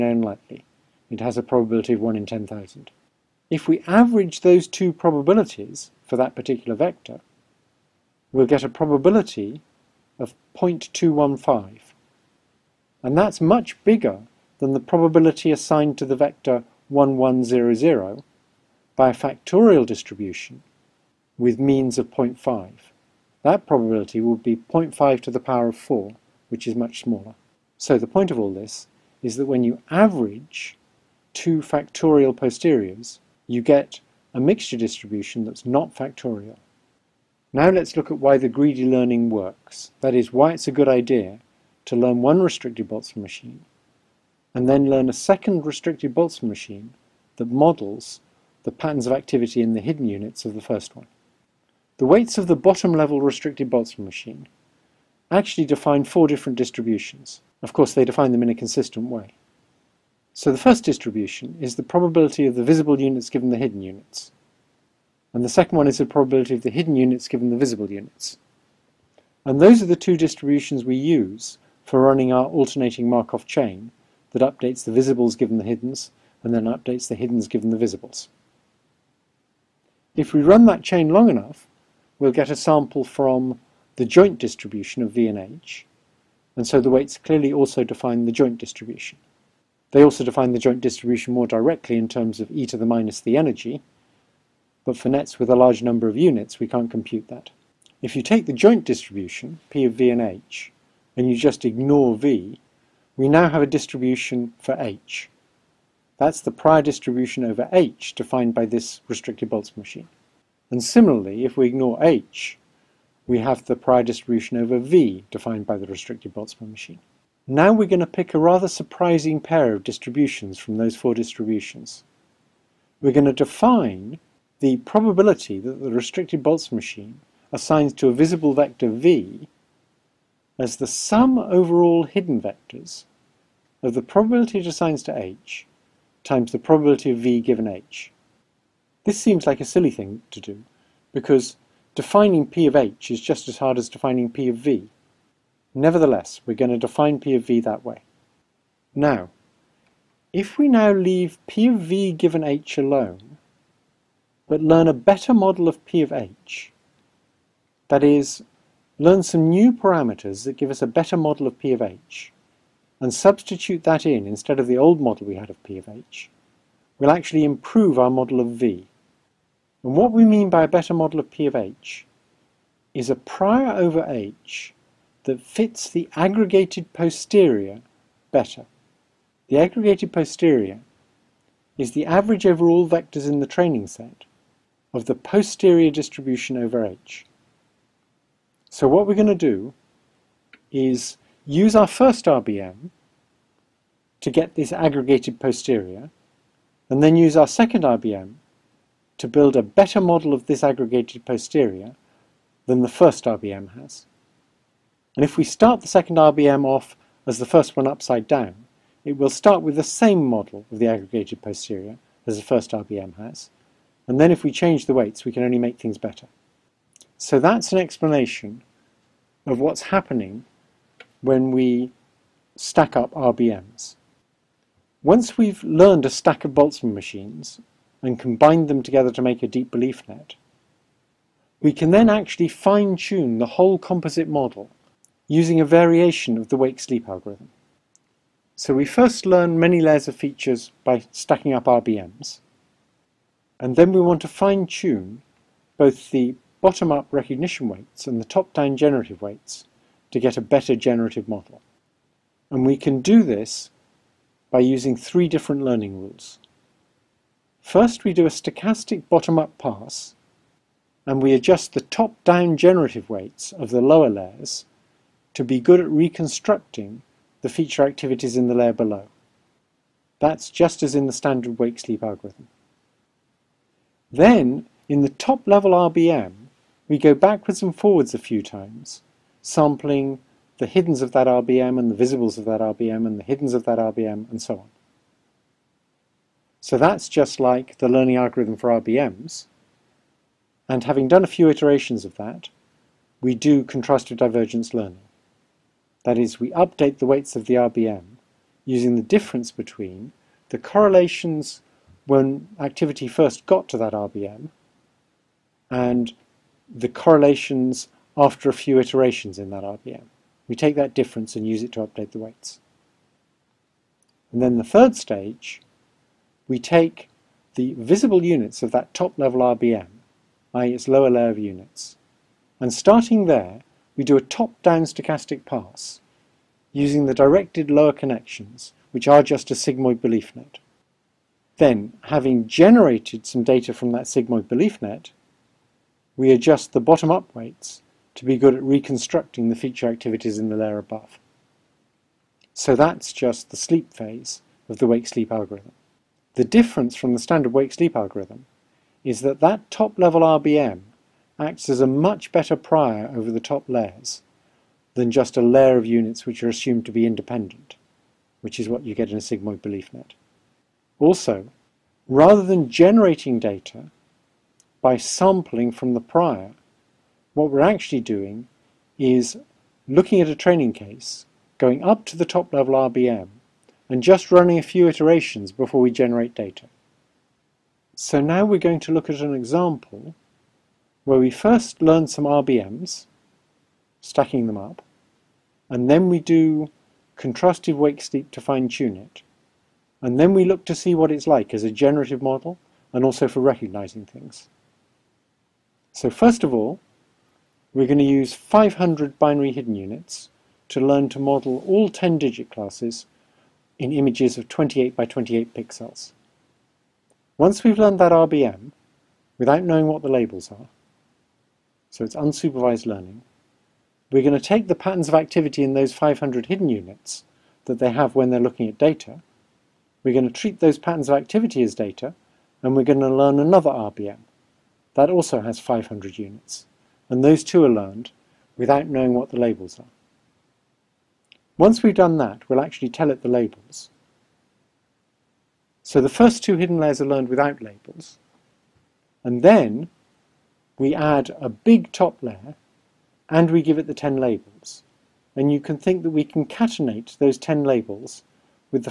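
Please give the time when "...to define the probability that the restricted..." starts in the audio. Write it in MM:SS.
02:03.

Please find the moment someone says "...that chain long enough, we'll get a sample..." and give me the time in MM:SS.
01:20.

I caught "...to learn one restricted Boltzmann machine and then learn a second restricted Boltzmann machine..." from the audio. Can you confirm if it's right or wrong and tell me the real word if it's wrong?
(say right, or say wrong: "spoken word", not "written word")
right.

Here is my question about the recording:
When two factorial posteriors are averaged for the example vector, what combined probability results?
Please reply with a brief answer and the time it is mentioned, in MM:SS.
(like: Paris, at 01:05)
0.215, at 00:10.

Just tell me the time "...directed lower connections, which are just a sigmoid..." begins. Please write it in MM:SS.
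05:27.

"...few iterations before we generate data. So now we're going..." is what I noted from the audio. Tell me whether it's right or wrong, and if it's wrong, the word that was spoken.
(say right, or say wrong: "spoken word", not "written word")
right.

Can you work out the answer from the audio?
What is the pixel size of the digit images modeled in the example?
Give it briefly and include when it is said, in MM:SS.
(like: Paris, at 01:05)
28 by 28, at 06:44.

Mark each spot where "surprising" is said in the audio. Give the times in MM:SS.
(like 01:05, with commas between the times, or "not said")
01:58.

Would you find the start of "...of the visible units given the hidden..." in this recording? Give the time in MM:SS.
01:02.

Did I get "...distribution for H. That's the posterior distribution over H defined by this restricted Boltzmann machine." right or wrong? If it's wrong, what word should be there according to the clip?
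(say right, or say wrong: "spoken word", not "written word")
wrong: "prior", not "posterior".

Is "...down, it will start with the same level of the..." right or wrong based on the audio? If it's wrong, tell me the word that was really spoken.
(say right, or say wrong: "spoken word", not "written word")
wrong: "model", not "level".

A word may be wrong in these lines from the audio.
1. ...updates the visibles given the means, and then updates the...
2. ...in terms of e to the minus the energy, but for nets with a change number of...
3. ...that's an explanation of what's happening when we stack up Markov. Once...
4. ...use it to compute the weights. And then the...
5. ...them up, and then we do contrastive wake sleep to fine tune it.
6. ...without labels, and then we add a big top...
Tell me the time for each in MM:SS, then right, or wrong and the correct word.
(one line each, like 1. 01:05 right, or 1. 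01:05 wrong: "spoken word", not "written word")
1. 01:14 wrong: "hiddens", not "means"
2. 01:31 wrong: "large", not "change"
3. 03:37 wrong: "RBMs", not "Markov"
4. 05:11 wrong: "update", not "compute"
5. 06:24 right
6. 07:17 right.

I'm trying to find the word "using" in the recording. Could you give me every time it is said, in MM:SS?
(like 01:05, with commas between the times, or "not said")
03:55, 04:14, 04:58, 05:26.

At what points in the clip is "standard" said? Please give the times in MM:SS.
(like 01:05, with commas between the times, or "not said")
04:31, 05:47.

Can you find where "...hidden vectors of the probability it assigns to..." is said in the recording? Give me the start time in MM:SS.
02:12.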